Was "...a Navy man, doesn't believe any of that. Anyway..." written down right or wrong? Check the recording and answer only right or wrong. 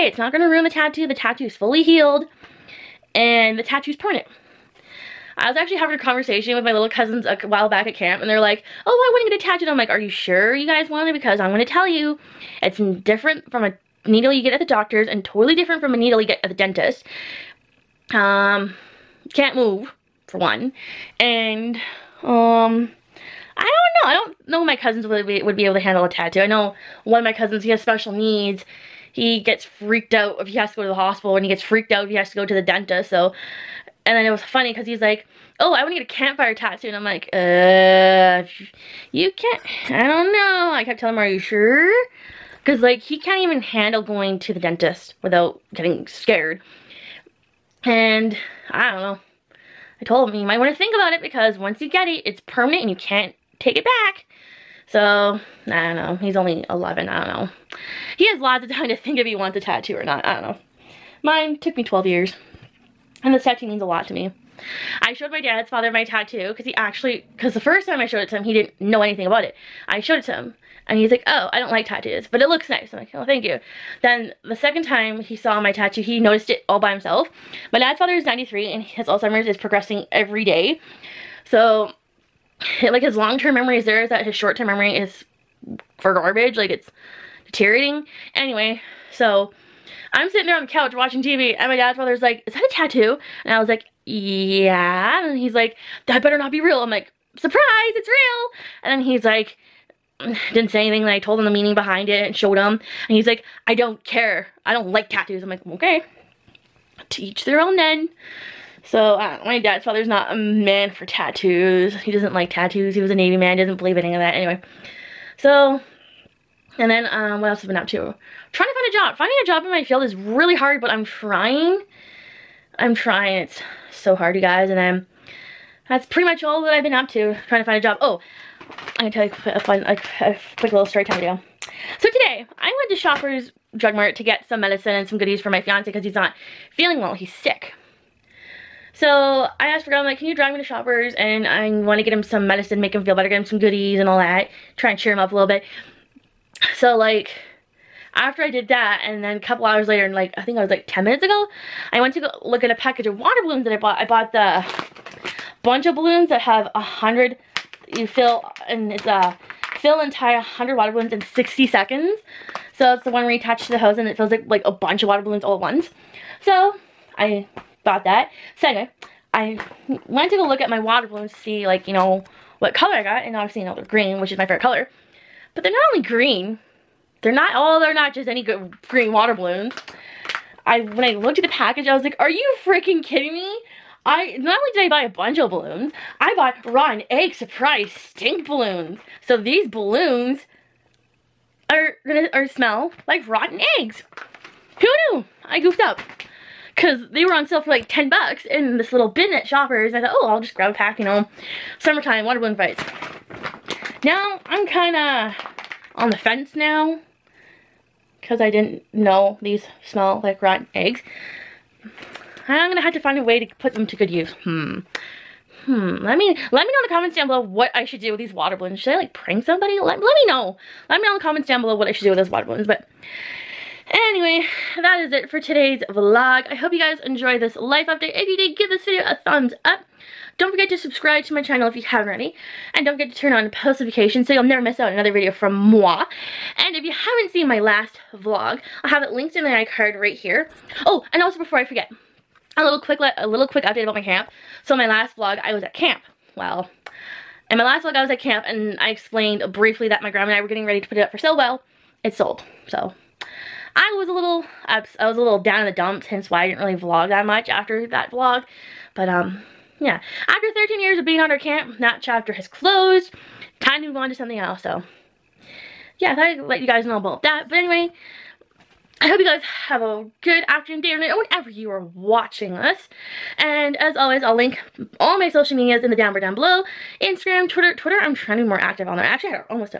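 right.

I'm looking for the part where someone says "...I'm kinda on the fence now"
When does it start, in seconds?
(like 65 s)
204 s.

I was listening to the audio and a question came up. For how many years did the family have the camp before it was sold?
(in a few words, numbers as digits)
13 years.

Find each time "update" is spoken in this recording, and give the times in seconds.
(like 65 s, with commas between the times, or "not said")
227 s, 243 s.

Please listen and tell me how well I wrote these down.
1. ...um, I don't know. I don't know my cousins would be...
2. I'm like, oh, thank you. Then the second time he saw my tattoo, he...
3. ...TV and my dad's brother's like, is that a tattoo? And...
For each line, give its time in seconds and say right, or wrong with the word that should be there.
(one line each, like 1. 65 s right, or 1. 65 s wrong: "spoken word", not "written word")
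1. 22 s right
2. 72 s right
3. 91 s right.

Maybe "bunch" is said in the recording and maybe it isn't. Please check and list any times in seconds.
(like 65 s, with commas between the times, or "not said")
155 s, 164 s, 185 s.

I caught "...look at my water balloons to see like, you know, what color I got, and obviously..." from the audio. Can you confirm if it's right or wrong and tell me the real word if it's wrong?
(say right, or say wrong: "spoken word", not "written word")
right.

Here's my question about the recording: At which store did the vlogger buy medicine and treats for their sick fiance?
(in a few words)
Shoppers Drug Mart.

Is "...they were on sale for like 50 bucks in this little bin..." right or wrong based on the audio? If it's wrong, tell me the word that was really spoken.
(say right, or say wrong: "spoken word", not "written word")
wrong: "10", not "50".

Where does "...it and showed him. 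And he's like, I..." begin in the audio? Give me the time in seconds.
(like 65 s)
102 s.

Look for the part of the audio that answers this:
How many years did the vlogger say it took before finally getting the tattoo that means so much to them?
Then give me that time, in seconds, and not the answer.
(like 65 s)
61 s.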